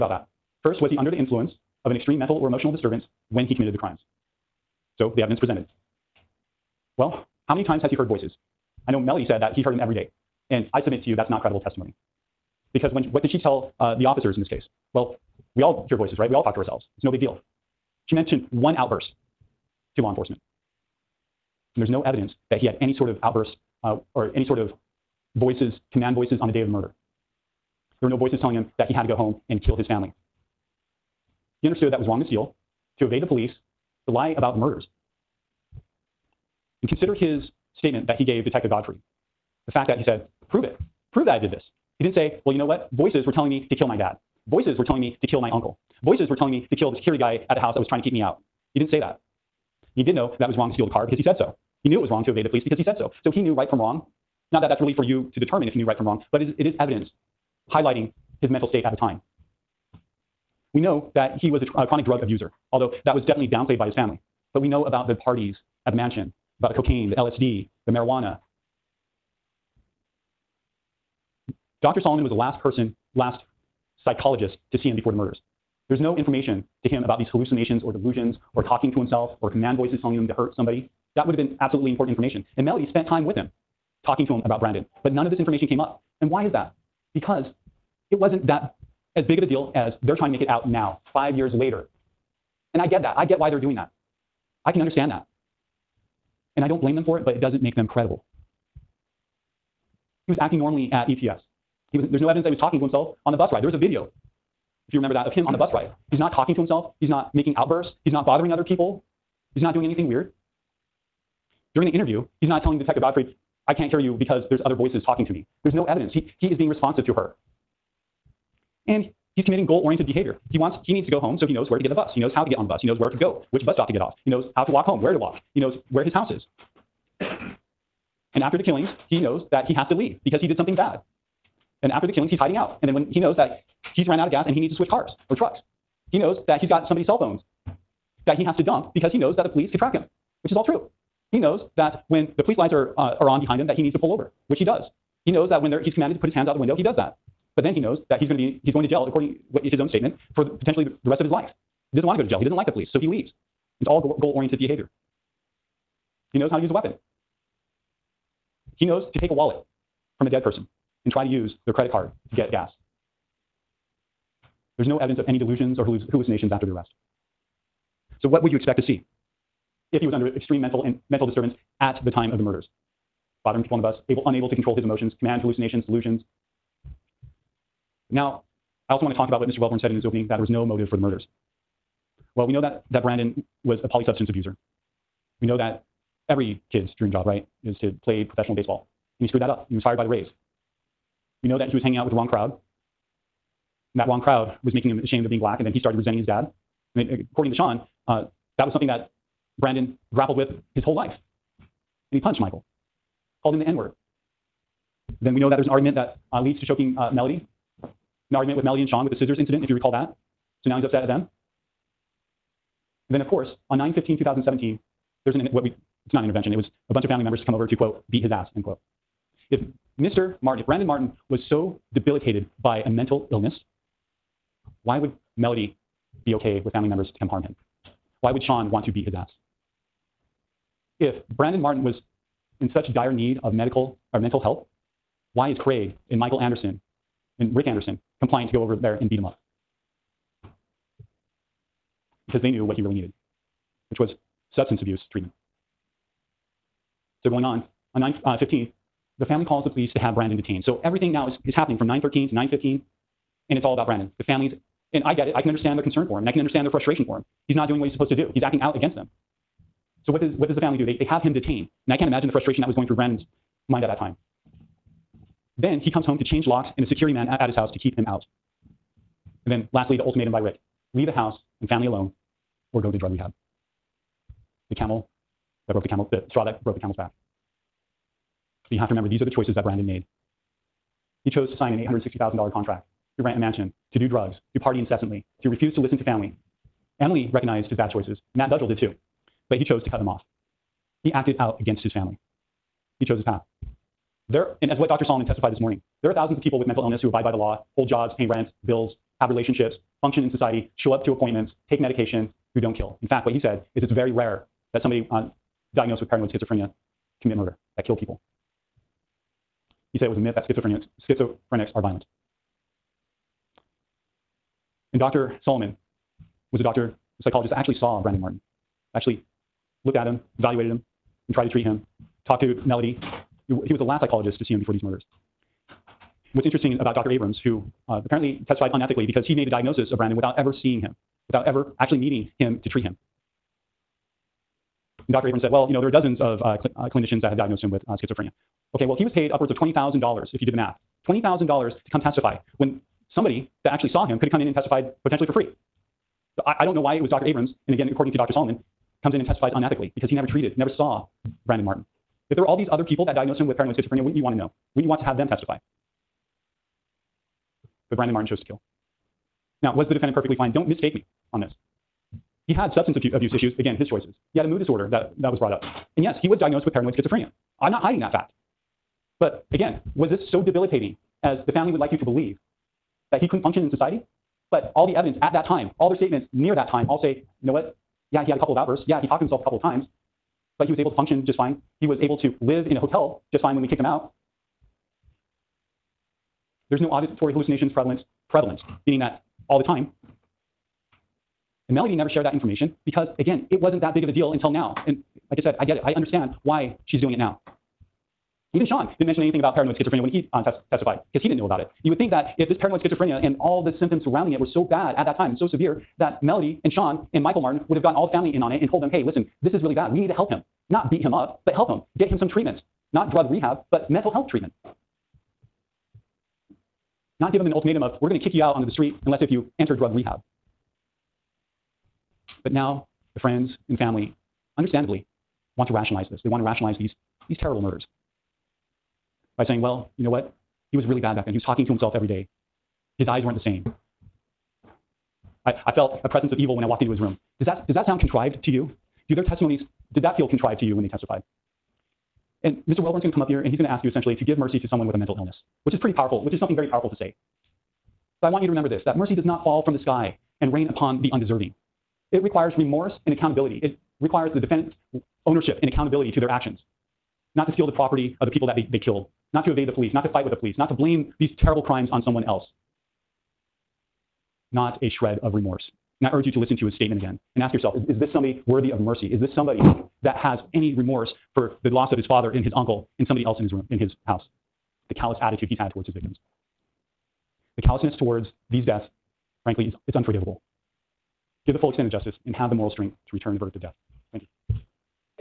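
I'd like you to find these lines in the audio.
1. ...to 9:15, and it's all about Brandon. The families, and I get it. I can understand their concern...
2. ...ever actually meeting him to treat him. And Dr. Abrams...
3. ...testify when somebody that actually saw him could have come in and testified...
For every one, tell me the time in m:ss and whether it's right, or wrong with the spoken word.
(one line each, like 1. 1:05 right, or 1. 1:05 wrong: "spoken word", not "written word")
1. 4:12 right
2. 5:31 right
3. 5:42 right.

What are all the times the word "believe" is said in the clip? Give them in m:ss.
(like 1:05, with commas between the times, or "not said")
6:12.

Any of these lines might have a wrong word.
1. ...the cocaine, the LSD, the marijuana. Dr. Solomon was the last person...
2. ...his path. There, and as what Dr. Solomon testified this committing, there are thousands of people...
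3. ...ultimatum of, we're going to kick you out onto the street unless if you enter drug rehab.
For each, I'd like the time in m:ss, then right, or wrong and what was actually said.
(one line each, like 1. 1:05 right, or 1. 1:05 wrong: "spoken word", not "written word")
1. 1:06 right
2. 4:53 wrong: "morning", not "committing"
3. 6:57 right.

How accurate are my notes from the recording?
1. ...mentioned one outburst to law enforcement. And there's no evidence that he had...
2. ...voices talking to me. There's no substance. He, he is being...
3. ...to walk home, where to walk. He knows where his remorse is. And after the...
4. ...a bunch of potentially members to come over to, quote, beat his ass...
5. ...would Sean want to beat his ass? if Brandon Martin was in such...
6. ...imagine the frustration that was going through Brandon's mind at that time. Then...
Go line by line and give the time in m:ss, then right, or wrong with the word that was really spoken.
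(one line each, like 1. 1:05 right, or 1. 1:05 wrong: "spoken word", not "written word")
1. 0:18 right
2. 1:54 wrong: "evidence", not "substance"
3. 2:04 wrong: "house", not "remorse"
4. 3:36 wrong: "family", not "potentially"
5. 3:48 right
6. 4:22 right.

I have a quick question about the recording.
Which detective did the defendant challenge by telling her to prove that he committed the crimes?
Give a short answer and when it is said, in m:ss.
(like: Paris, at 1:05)
Detective Godfrey, at 0:38.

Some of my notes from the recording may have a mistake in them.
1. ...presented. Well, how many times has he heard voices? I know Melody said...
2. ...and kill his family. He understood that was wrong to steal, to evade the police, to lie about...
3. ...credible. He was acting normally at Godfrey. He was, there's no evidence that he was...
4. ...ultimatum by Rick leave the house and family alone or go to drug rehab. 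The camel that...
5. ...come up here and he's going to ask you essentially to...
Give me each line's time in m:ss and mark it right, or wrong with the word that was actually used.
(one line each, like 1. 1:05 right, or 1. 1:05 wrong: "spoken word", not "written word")
1. 0:05 right
2. 0:29 right
3. 1:37 wrong: "ETS", not "Godfrey"
4. 4:30 right
5. 7:23 right.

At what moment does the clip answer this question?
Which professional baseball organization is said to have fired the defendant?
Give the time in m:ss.
3:10.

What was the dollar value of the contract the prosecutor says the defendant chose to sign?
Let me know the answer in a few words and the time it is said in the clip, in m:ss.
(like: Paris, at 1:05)
$860,000, at 4:41.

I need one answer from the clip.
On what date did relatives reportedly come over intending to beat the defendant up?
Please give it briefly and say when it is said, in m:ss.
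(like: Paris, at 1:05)
9-15-2017, at 3:33.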